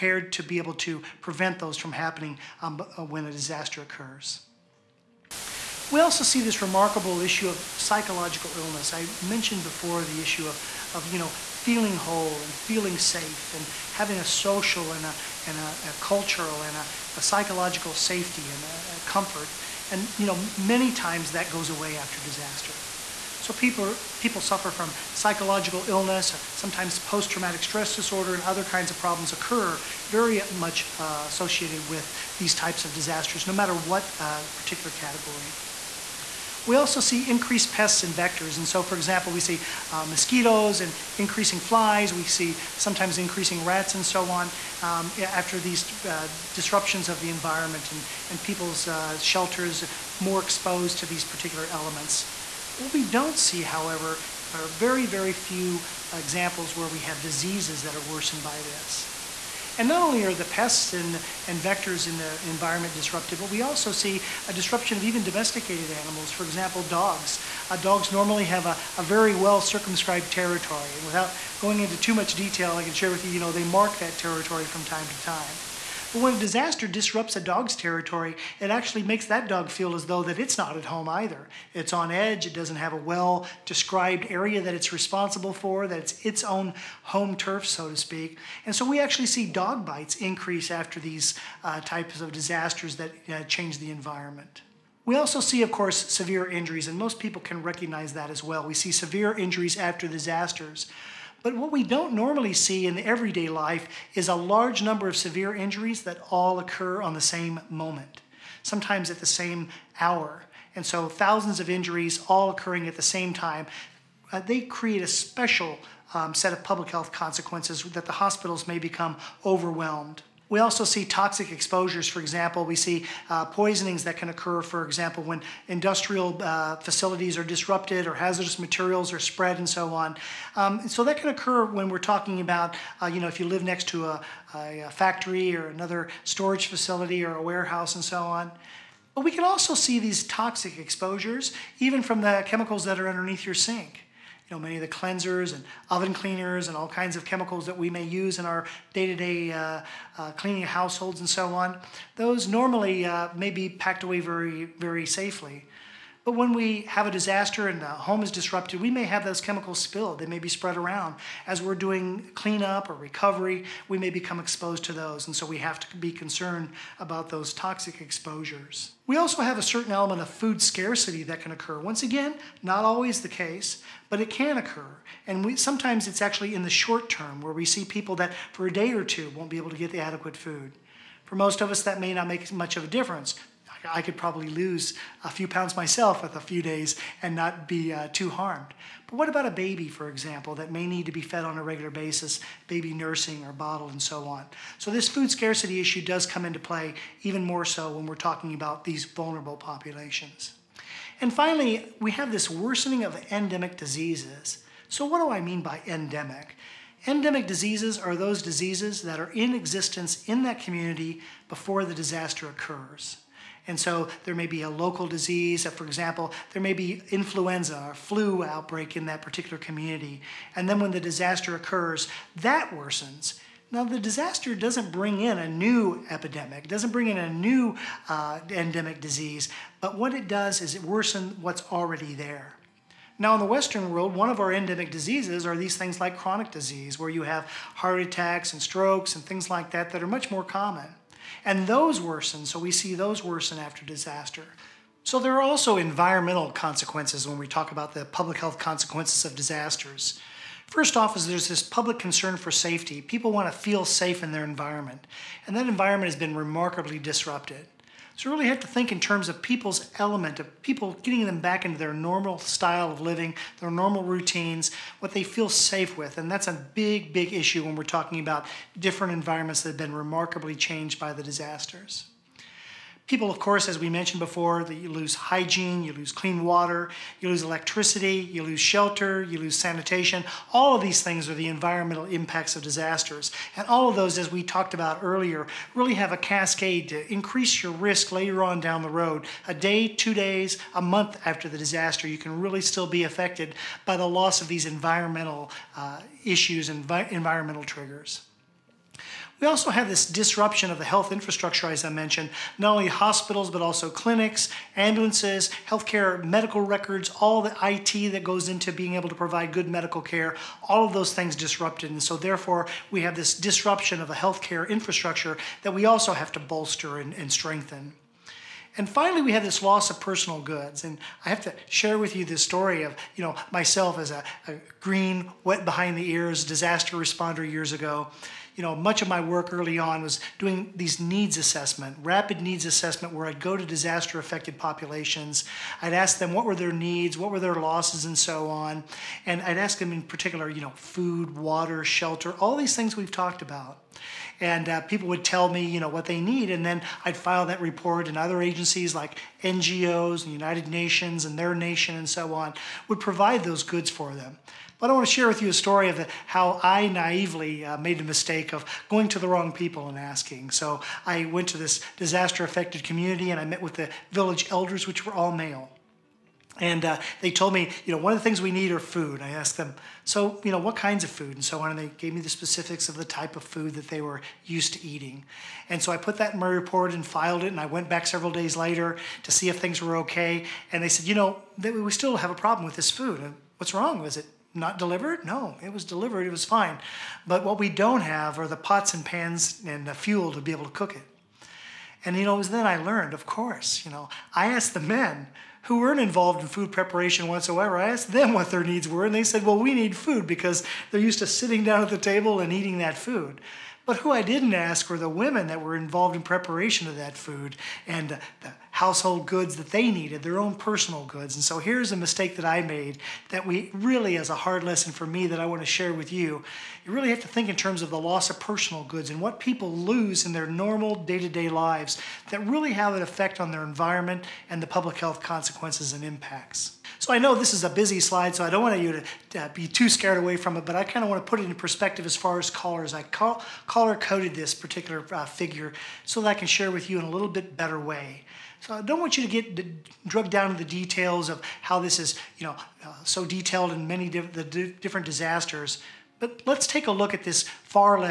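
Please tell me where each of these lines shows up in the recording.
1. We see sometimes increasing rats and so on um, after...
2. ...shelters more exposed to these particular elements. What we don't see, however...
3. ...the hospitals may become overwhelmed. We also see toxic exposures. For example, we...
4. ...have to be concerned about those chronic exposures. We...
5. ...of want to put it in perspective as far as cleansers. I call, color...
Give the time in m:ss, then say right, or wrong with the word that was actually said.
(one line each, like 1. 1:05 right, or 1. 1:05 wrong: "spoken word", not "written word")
1. 0:42 right
2. 0:49 right
3. 1:58 right
4. 2:45 wrong: "toxic", not "chronic"
5. 7:11 wrong: "callers", not "cleansers".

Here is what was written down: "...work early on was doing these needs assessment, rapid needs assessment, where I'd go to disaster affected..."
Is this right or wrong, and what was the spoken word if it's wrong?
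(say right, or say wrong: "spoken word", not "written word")
right.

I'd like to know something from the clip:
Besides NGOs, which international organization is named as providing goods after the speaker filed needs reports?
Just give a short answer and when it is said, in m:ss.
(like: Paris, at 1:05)
United Nations, at 5:50.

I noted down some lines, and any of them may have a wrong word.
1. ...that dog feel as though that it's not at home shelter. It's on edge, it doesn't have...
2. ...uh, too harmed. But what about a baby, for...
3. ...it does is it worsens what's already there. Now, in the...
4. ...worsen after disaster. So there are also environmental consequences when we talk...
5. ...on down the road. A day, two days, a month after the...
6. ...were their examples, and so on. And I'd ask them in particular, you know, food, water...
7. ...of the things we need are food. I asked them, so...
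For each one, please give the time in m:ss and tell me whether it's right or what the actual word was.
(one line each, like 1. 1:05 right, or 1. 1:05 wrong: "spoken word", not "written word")
1. 1:19 wrong: "either", not "shelter"
2. 3:07 right
3. 3:50 right
4. 4:03 right
5. 4:48 right
6. 5:37 wrong: "losses", not "examples"
7. 6:08 right.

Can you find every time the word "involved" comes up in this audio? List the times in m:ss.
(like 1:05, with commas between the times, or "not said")
6:35, 6:45.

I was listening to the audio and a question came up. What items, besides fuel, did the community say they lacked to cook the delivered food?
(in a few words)
Pots and pans.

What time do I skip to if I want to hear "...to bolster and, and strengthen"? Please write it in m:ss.
5:16.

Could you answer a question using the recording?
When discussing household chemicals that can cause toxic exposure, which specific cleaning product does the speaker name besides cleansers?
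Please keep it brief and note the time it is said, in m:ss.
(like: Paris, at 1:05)
Oven cleaners, at 2:25.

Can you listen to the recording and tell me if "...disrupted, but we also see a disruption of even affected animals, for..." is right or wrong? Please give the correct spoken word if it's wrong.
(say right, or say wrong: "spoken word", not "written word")
wrong: "domesticated", not "affected".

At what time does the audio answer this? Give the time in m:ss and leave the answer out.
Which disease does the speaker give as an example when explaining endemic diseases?
3:37.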